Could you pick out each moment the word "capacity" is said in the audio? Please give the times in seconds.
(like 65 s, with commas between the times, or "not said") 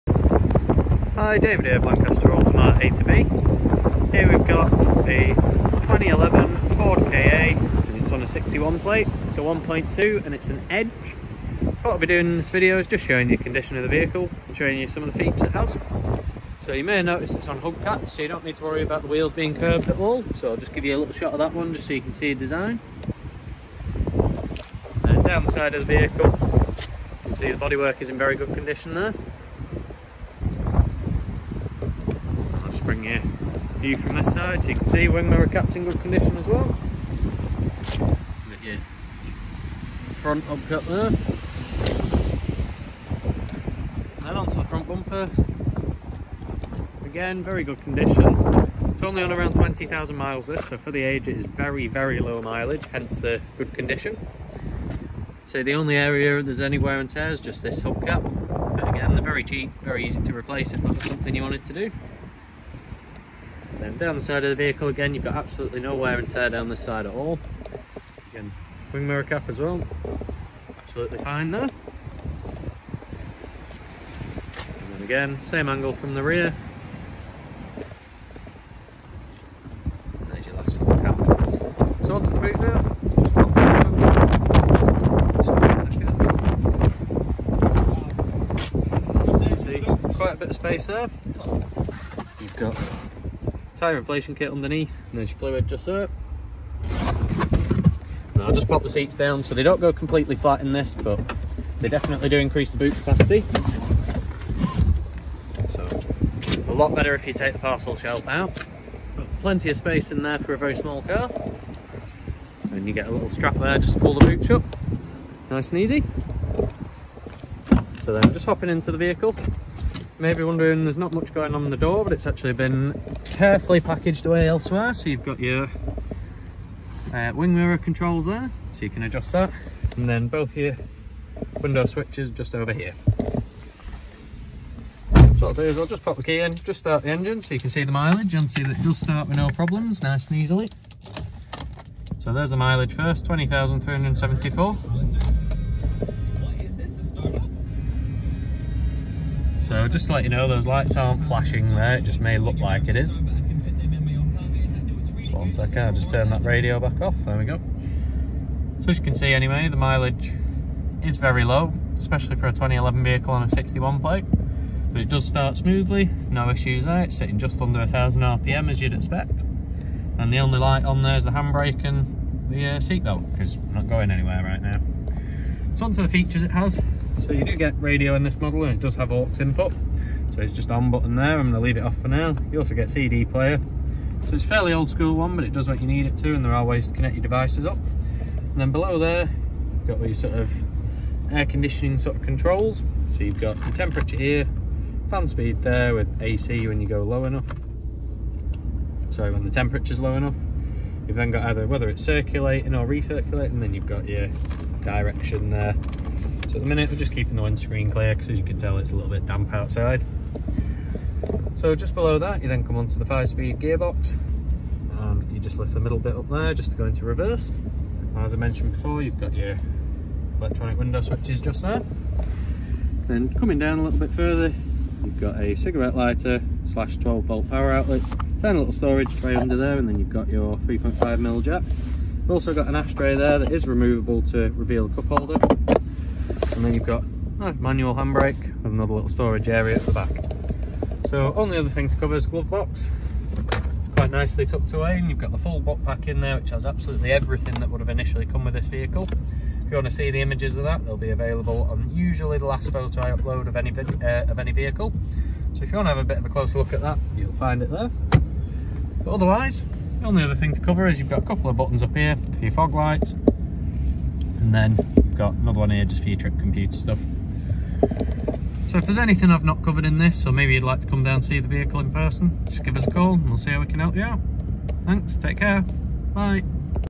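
102 s.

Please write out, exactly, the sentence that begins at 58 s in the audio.
But again, they're very cheap, very easy to replace if that was something you wanted to do.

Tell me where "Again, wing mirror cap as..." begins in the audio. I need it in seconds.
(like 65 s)
68 s.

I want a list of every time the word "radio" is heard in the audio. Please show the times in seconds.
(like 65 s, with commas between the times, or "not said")
156 s, 177 s.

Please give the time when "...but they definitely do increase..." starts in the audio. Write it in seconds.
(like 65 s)
100 s.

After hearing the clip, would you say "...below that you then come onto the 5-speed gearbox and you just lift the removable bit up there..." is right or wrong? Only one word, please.
wrong.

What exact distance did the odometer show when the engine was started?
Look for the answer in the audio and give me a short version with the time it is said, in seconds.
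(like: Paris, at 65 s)
20,374, at 143 s.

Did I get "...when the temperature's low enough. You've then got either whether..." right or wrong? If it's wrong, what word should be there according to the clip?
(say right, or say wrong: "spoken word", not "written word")
right.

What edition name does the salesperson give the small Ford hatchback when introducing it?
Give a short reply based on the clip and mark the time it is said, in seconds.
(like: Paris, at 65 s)
Edge, at 10 s.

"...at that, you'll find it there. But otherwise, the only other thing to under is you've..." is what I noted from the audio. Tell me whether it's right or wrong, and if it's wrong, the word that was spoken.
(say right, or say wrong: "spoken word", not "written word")
wrong: "cover", not "under".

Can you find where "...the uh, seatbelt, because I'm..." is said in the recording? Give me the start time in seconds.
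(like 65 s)
172 s.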